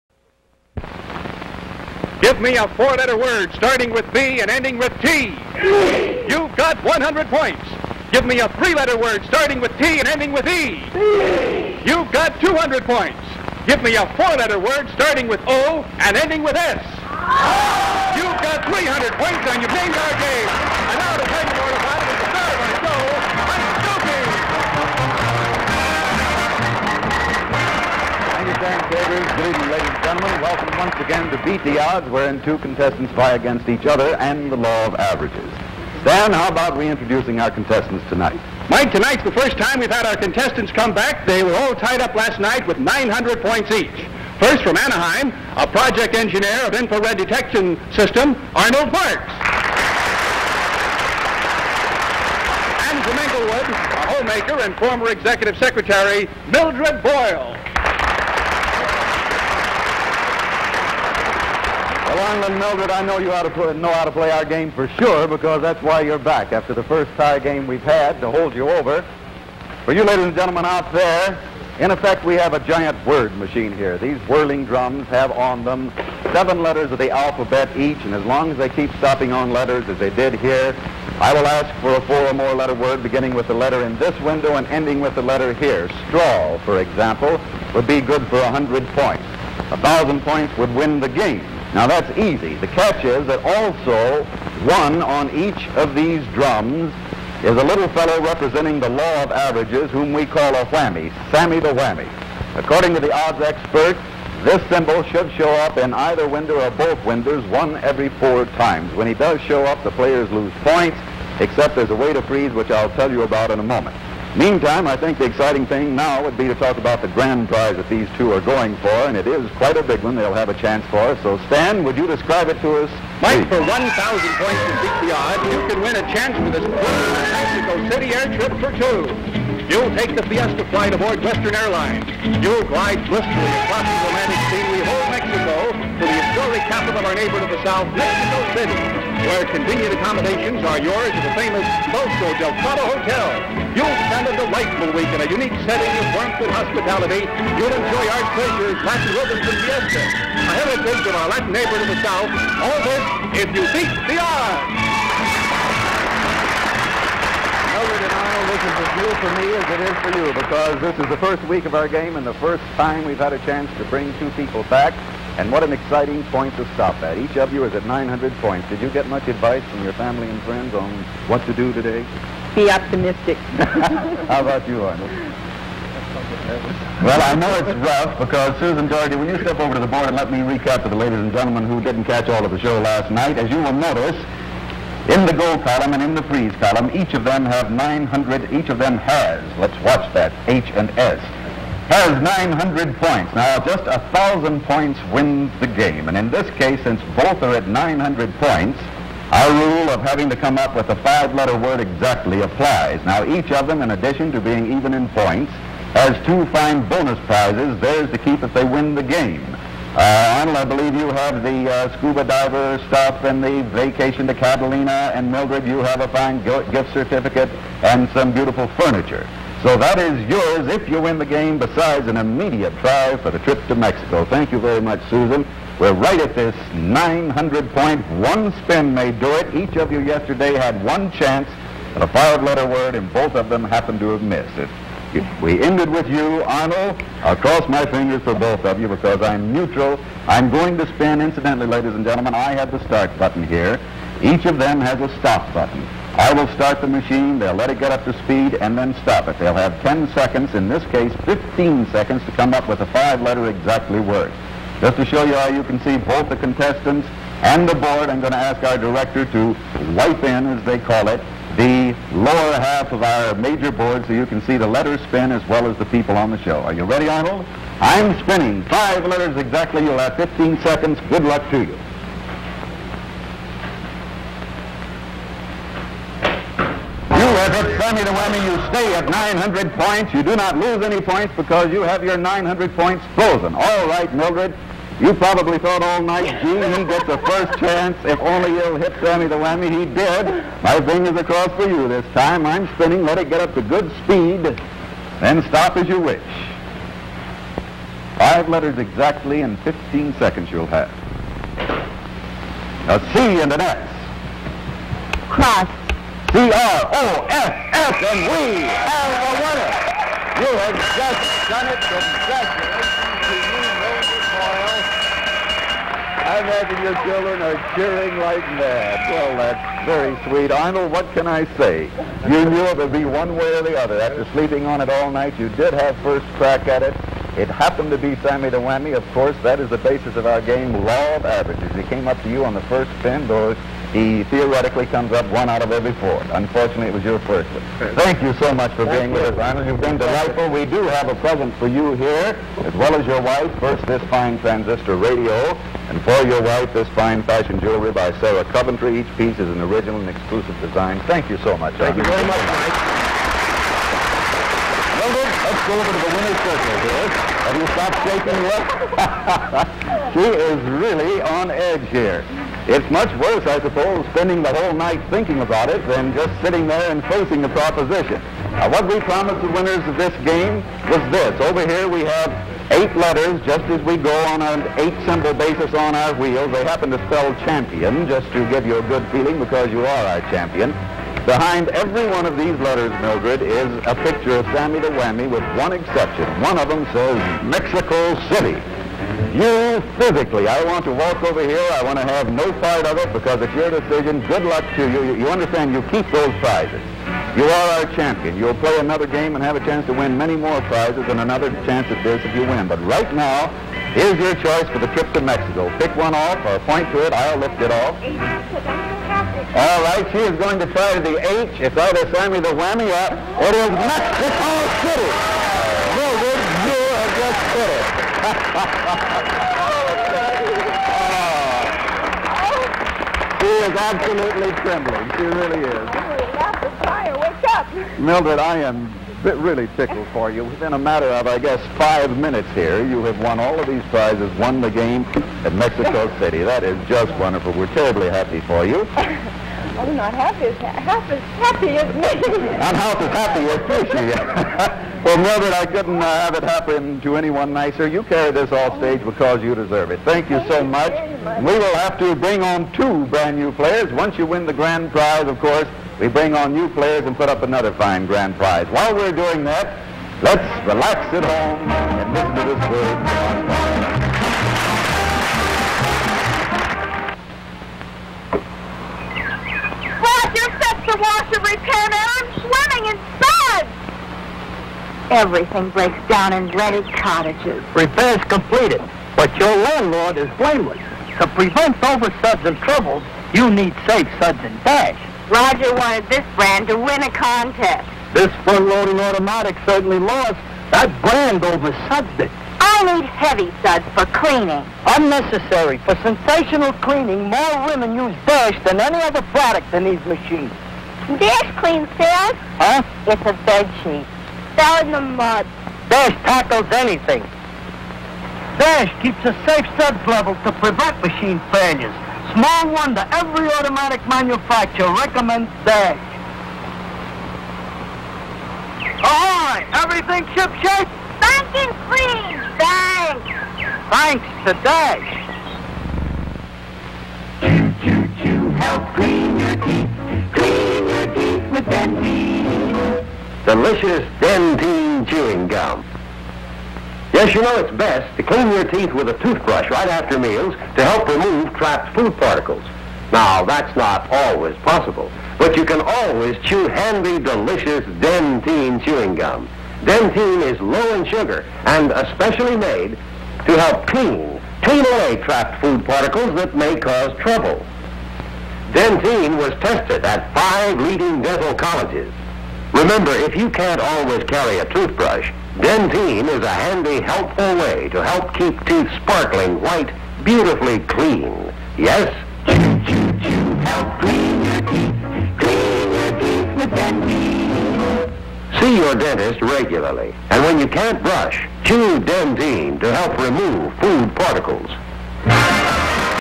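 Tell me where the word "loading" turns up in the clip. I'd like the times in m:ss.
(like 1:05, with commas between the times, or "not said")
8:08.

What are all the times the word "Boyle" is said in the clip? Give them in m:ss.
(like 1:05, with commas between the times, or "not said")
0:57, 5:14.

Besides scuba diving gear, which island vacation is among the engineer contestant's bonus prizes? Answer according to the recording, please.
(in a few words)
Catalina.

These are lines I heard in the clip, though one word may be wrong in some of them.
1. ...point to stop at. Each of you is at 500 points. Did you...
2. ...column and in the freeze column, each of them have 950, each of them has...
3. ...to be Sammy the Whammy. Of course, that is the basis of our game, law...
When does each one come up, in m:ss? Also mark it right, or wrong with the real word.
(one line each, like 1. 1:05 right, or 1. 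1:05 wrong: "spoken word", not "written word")
1. 2:46 wrong: "900", not "500"
2. 3:05 wrong: "900", not "950"
3. 5:27 right.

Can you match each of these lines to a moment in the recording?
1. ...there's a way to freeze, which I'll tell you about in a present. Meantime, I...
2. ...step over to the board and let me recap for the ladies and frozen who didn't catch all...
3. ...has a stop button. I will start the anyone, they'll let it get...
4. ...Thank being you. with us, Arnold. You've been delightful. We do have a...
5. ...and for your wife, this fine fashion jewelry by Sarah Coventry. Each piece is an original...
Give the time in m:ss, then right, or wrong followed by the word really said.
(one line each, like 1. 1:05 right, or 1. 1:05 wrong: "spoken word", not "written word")
1. 1:51 wrong: "moment", not "present"
2. 2:59 wrong: "gentlemen", not "frozen"
3. 4:04 wrong: "machine", not "anyone"
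4. 5:38 right
5. 5:45 right.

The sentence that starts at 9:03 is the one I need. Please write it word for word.
Now, that's not always possible, but you can always chew handy, delicious Dentyne chewing gum.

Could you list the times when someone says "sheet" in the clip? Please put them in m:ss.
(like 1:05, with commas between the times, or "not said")
8:23.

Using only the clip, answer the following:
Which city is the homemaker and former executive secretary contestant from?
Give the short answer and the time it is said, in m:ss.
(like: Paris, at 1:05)
Englewood, at 0:53.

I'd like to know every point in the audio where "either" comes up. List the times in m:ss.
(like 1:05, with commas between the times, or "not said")
1:45, 6:51.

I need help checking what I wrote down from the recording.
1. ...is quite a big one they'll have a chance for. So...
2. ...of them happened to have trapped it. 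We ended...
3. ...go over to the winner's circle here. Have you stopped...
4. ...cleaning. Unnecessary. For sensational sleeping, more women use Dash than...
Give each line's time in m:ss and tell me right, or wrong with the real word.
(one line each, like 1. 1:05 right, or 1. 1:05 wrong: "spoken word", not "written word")
1. 1:59 right
2. 3:53 wrong: "missed", not "trapped"
3. 5:55 right
4. 8:14 wrong: "cleaning", not "sleeping".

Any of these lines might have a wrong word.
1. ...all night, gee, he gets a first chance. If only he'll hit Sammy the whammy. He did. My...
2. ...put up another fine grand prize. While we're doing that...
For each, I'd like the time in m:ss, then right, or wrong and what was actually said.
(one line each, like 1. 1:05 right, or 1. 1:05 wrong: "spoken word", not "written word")
1. 4:45 right
2. 7:37 right.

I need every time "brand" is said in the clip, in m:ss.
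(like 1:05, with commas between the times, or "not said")
7:33, 8:06, 8:11.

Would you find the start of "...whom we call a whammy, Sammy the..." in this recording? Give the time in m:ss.
1:39.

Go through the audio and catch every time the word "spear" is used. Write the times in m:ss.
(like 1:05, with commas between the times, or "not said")
not said.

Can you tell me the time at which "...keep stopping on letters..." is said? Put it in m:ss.
1:18.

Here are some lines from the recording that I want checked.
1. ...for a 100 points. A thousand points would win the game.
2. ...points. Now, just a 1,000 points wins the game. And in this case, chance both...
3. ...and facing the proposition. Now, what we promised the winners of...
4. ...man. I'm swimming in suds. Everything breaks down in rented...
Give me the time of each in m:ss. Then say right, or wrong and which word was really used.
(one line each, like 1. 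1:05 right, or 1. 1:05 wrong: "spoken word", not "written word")
1. 1:28 right
2. 3:12 wrong: "since", not "chance"
3. 6:06 right
4. 7:51 right.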